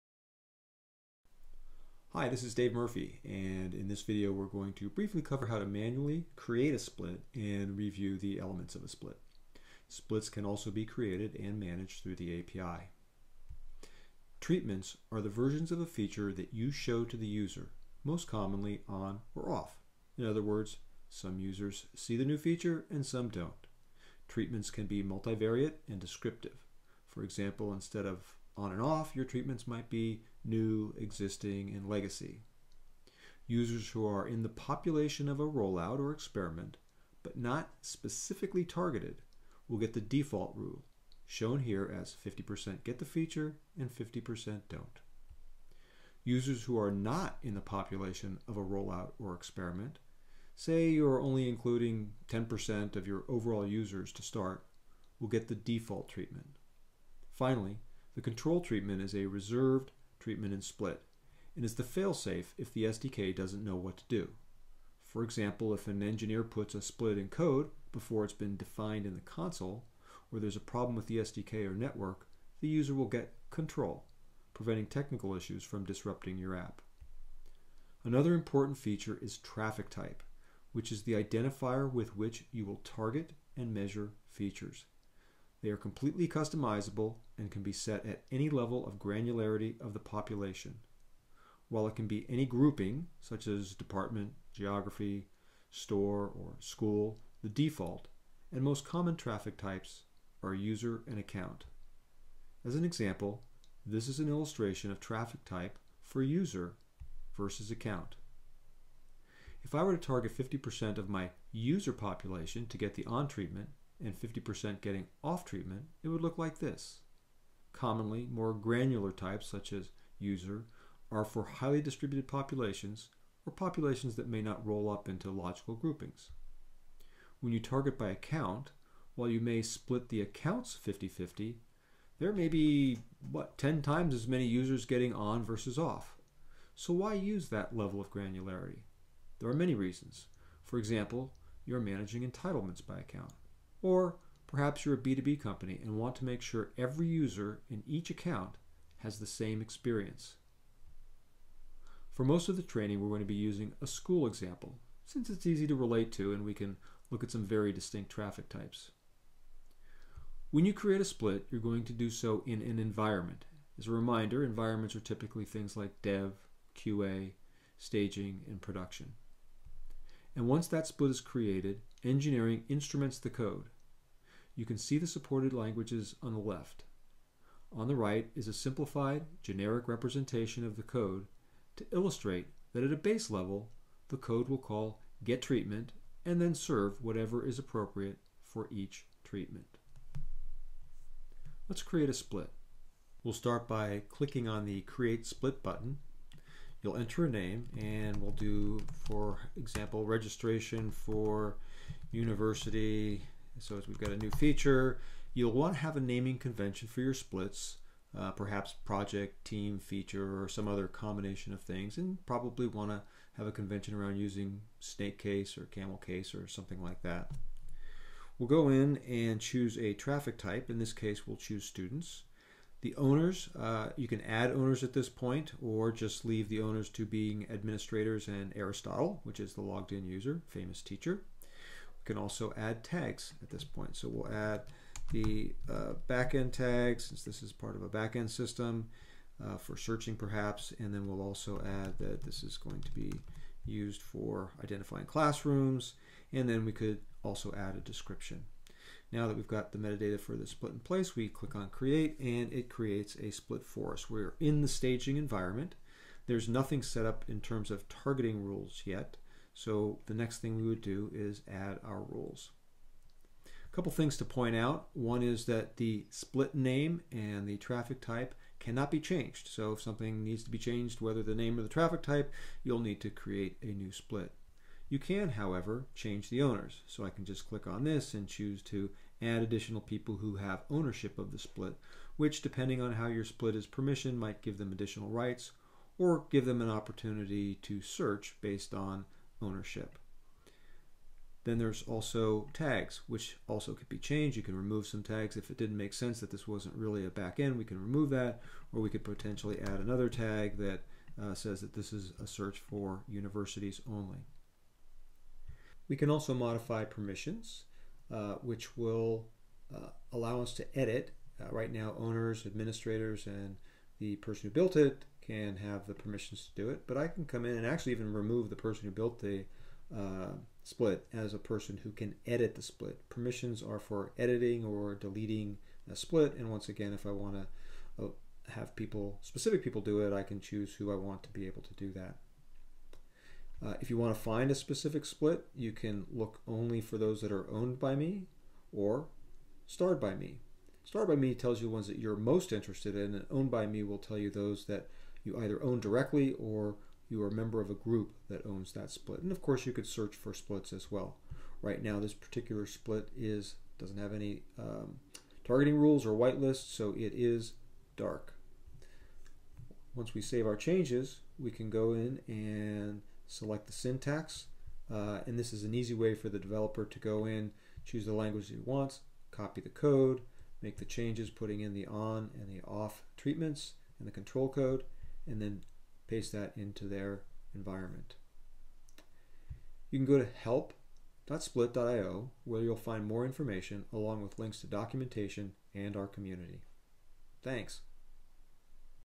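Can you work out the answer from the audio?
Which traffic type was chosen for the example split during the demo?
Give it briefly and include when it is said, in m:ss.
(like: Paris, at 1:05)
students, at 3:41.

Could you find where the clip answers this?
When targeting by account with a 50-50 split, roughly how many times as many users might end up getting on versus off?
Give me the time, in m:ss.
2:13.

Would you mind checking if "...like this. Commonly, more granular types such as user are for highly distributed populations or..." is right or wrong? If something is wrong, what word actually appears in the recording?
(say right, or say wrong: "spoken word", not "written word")
right.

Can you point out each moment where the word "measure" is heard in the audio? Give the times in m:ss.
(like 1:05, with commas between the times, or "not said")
1:23.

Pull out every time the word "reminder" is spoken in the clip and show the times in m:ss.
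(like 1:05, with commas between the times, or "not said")
2:43.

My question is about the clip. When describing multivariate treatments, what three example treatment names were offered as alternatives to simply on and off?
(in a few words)
new, existing, and legacy.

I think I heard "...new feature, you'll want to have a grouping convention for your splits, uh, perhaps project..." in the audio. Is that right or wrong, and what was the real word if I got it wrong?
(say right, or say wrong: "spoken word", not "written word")
wrong: "naming", not "grouping".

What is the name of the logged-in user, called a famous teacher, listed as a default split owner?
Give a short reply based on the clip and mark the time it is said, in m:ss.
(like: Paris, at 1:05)
Aristotle, at 3:48.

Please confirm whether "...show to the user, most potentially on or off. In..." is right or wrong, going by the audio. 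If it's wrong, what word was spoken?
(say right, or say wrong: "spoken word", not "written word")
wrong: "commonly", not "potentially".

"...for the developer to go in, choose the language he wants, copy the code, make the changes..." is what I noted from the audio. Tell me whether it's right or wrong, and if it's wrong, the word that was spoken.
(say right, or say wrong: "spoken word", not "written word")
right.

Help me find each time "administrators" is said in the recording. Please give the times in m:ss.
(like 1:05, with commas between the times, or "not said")
3:47, 5:12.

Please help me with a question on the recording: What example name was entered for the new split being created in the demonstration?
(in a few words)
registration for university.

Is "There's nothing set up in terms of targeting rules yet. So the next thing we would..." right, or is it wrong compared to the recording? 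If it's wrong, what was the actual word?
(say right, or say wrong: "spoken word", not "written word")
right.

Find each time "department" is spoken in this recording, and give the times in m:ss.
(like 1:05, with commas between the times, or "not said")
1:33.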